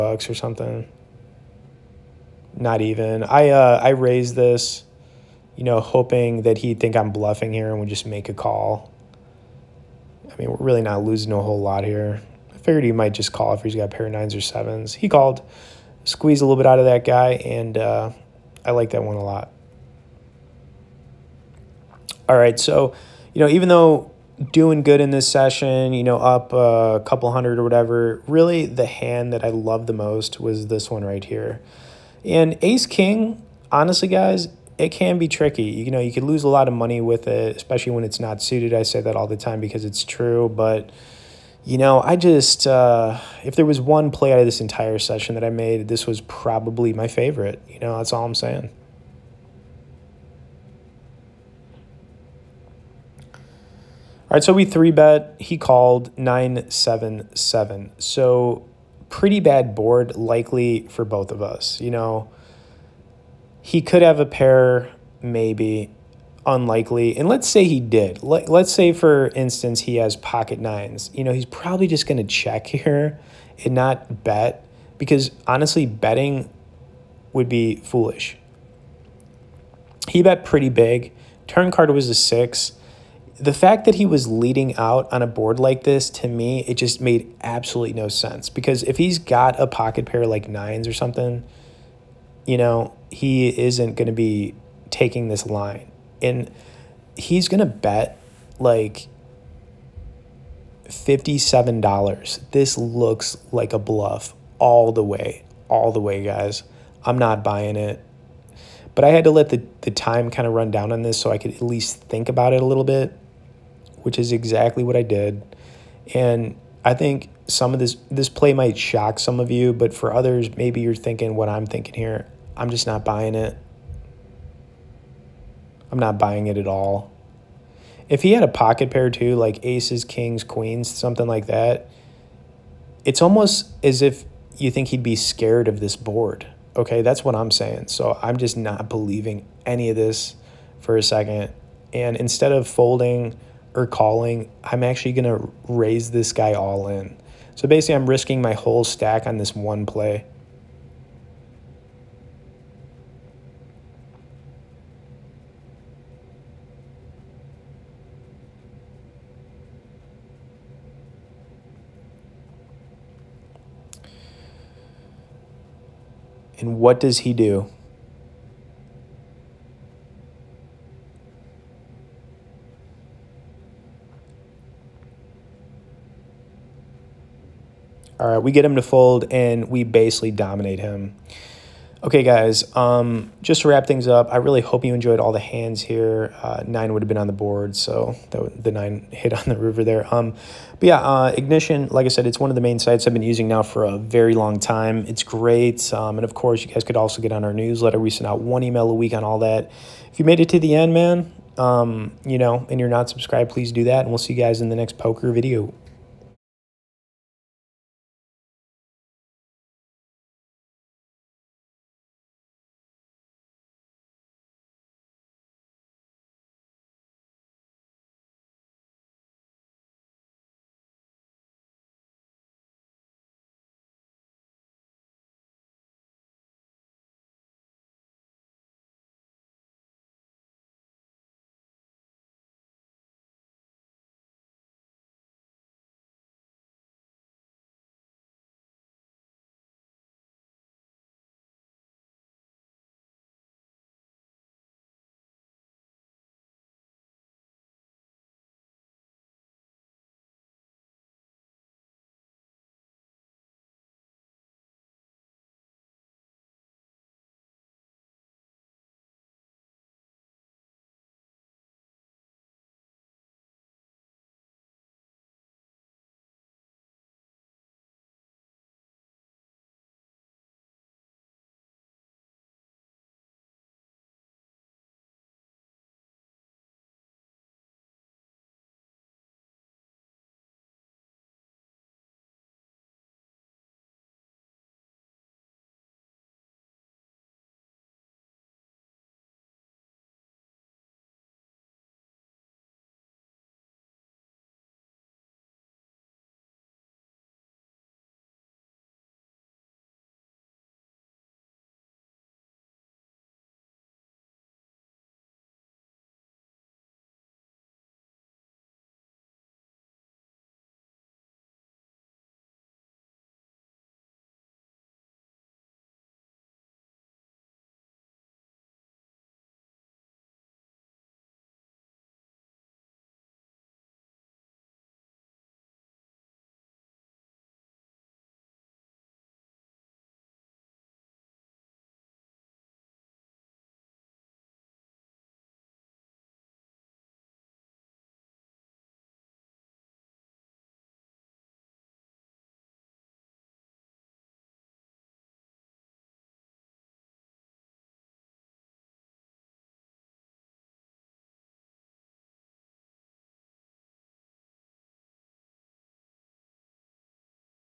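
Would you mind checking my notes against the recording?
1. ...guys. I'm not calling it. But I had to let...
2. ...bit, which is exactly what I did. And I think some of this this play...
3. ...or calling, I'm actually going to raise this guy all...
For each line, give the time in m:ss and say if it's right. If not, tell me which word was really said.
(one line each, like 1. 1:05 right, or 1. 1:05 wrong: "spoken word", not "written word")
1. 1:46 wrong: "buying", not "calling"
2. 1:52 right
3. 2:23 right.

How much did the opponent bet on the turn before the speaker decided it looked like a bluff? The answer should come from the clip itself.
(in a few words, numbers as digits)
$57.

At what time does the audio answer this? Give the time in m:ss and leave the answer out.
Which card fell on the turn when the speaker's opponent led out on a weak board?
1:22.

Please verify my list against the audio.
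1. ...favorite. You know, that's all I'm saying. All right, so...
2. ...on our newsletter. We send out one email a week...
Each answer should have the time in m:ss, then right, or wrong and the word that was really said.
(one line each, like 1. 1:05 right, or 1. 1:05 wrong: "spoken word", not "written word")
1. 0:47 right
2. 3:17 right.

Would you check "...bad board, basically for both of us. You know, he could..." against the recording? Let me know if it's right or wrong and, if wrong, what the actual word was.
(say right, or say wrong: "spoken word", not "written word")
wrong: "likely", not "basically".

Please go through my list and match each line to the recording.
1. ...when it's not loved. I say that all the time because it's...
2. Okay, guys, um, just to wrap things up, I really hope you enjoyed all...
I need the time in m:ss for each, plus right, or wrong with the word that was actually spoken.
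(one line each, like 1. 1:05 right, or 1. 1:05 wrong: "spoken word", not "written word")
1. 0:37 wrong: "suited", not "loved"
2. 3:02 right.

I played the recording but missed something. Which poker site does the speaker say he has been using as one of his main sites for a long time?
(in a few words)
Ignition.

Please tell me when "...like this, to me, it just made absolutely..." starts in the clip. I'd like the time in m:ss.
1:25.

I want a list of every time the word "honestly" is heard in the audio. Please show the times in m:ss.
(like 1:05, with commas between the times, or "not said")
0:33, 1:15.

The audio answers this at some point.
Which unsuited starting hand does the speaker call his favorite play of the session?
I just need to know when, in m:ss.
0:32.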